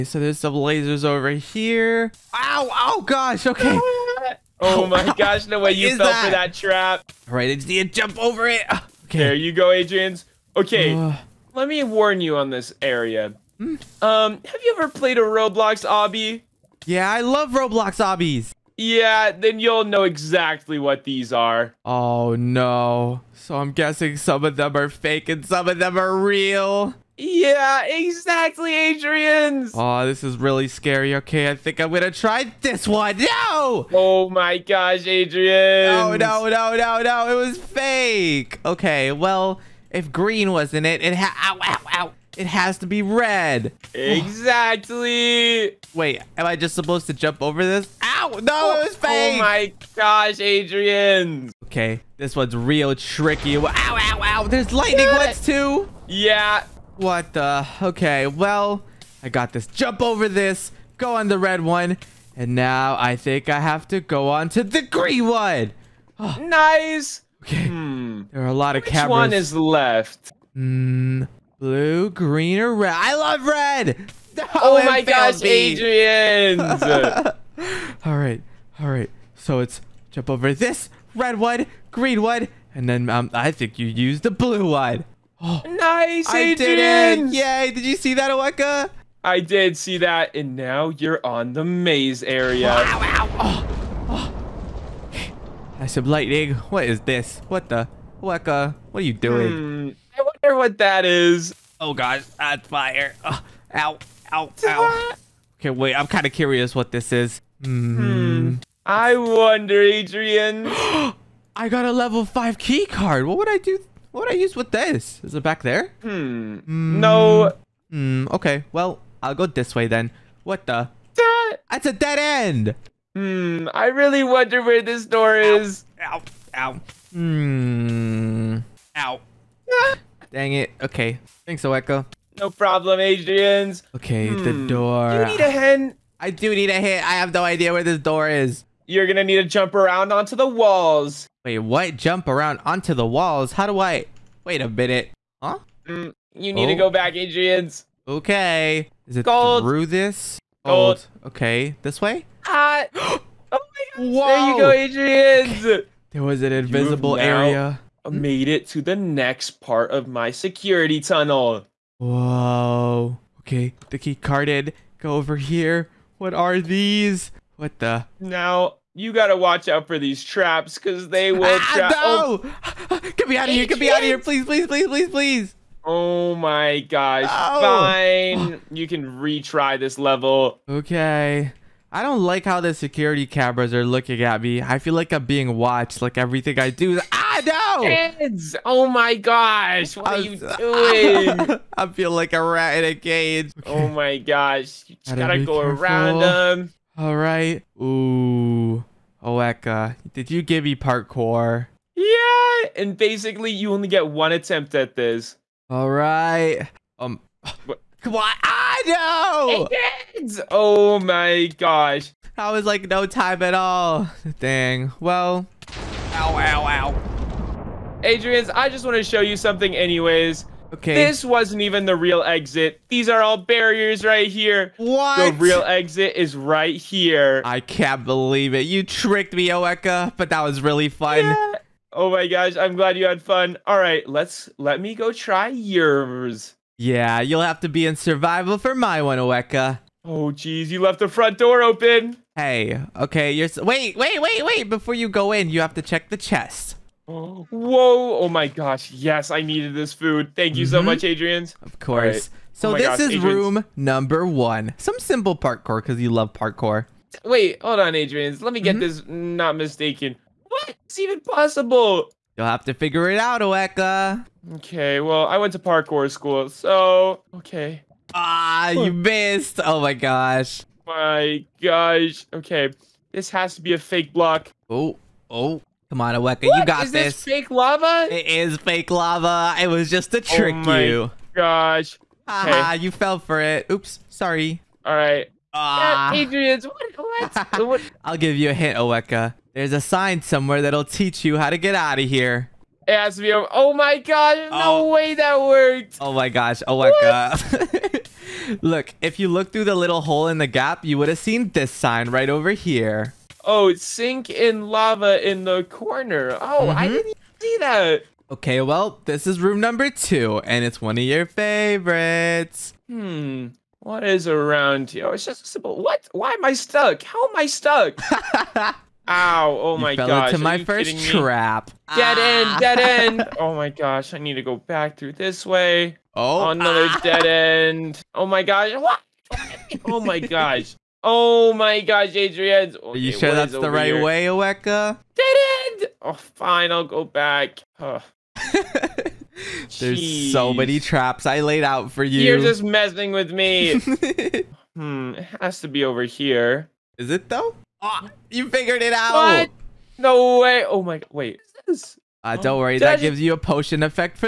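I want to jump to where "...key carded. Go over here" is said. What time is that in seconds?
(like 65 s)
163 s.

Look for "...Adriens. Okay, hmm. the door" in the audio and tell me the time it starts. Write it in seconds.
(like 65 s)
132 s.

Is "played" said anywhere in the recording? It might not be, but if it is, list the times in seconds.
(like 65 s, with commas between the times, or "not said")
14 s.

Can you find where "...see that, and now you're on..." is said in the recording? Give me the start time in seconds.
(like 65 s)
89 s.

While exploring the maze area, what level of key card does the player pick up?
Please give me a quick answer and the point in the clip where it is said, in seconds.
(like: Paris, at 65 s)
Level 5, at 111 s.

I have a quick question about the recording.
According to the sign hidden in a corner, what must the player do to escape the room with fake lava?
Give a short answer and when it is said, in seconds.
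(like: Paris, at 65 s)
Sink in lava, at 303 s.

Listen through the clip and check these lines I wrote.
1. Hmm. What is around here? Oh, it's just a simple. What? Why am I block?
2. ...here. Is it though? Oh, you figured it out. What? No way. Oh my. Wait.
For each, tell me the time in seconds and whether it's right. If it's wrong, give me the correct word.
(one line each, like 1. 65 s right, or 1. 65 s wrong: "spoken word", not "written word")
1. 312 s wrong: "stuck", not "block"
2. 346 s right.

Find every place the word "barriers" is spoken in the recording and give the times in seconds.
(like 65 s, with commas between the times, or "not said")
223 s.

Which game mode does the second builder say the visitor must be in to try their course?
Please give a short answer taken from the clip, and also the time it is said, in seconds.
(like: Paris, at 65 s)
Survival, at 237 s.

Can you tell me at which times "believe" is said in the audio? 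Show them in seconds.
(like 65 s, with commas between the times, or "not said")
228 s.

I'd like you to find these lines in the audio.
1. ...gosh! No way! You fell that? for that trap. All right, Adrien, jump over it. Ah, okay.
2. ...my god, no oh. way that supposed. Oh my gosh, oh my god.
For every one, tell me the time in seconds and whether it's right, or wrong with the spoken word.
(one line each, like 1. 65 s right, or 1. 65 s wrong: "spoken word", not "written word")
1. 5 s right
2. 293 s wrong: "worked", not "supposed".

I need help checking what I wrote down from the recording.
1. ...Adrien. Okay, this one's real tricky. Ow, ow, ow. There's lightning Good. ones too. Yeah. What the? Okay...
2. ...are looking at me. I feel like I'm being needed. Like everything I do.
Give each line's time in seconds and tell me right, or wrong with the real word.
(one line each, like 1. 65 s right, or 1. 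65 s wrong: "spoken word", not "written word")
1. 50 s right
2. 183 s wrong: "watched", not "needed".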